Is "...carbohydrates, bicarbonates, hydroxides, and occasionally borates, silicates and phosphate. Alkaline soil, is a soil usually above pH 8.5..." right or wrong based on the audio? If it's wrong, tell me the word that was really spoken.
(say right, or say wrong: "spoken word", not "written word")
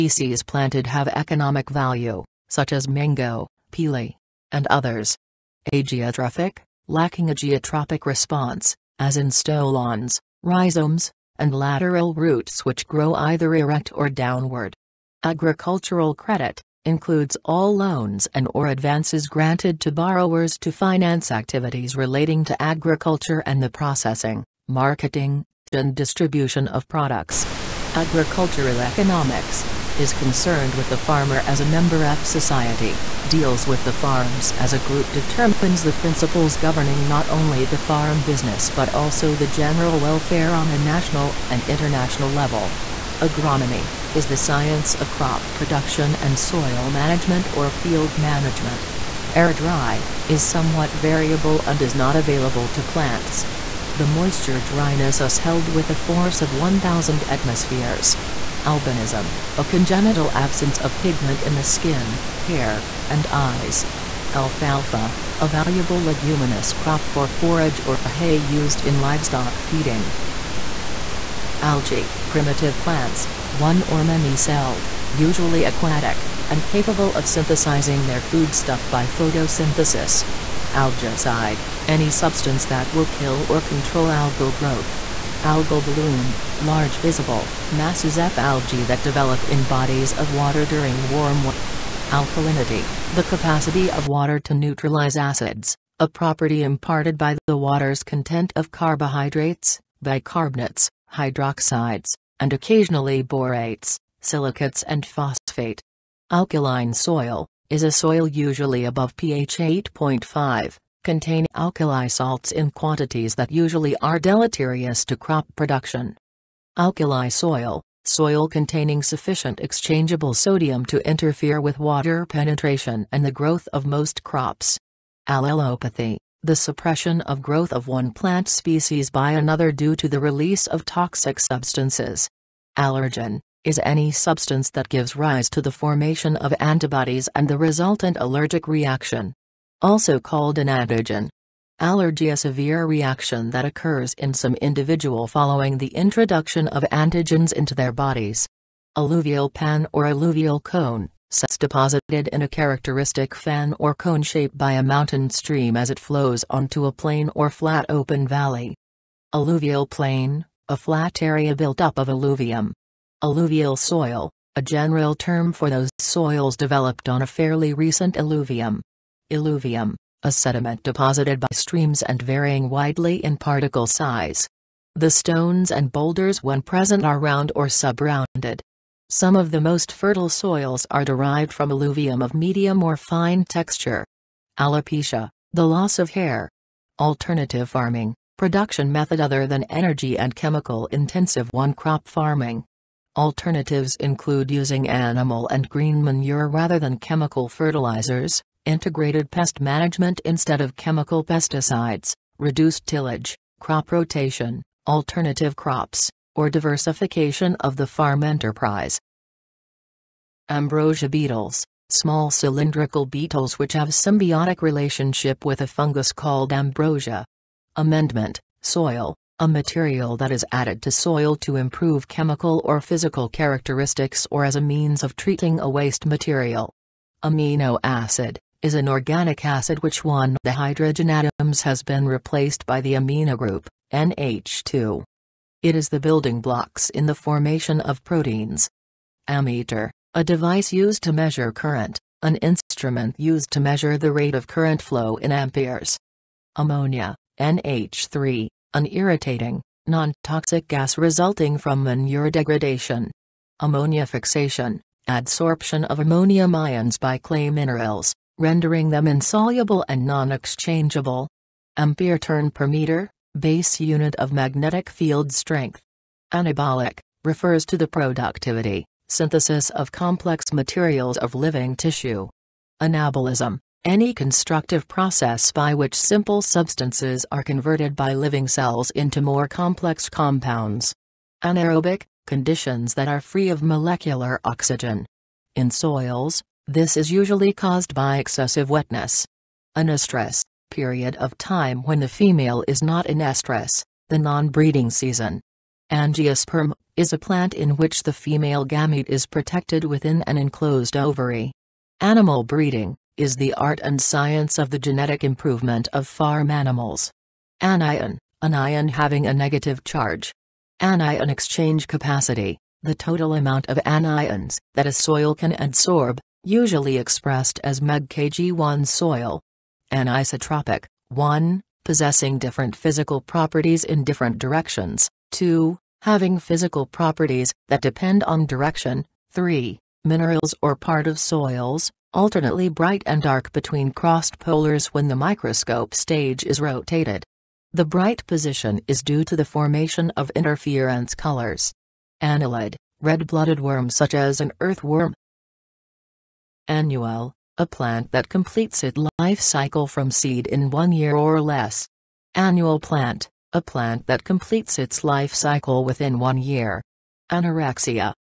right.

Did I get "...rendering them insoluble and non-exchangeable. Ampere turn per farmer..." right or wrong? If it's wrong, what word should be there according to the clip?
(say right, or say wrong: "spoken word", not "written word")
wrong: "meter", not "farmer".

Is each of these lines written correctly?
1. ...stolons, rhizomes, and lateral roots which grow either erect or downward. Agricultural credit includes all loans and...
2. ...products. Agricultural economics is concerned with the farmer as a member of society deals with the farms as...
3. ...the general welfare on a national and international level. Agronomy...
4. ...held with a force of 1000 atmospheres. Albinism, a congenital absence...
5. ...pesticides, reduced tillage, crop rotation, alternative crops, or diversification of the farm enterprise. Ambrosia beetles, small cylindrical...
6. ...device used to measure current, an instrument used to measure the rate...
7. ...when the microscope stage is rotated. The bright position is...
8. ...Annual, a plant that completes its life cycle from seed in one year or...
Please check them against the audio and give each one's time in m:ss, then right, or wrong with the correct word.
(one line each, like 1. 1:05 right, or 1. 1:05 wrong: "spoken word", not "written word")
1. 0:09 right
2. 0:26 right
3. 0:39 right
4. 0:55 right
5. 3:21 right
6. 4:00 right
7. 5:34 right
8. 5:46 right.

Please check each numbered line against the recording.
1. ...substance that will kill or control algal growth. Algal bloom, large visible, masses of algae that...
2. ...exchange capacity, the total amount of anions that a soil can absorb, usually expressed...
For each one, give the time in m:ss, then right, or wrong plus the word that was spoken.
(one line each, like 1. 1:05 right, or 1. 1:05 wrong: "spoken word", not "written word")
1. 1:22 right
2. 5:11 right.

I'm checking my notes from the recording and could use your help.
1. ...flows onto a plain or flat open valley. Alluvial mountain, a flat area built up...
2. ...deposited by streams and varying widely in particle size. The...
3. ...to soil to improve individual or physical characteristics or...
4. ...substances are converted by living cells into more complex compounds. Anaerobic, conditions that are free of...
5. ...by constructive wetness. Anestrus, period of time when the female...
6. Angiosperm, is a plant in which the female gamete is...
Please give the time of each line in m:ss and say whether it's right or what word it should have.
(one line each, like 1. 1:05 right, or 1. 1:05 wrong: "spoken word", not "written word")
1. 2:35 wrong: "plain", not "mountain"
2. 2:50 right
3. 3:40 wrong: "chemical", not "individual"
4. 4:36 right
5. 4:47 wrong: "excessive", not "constructive"
6. 4:55 right.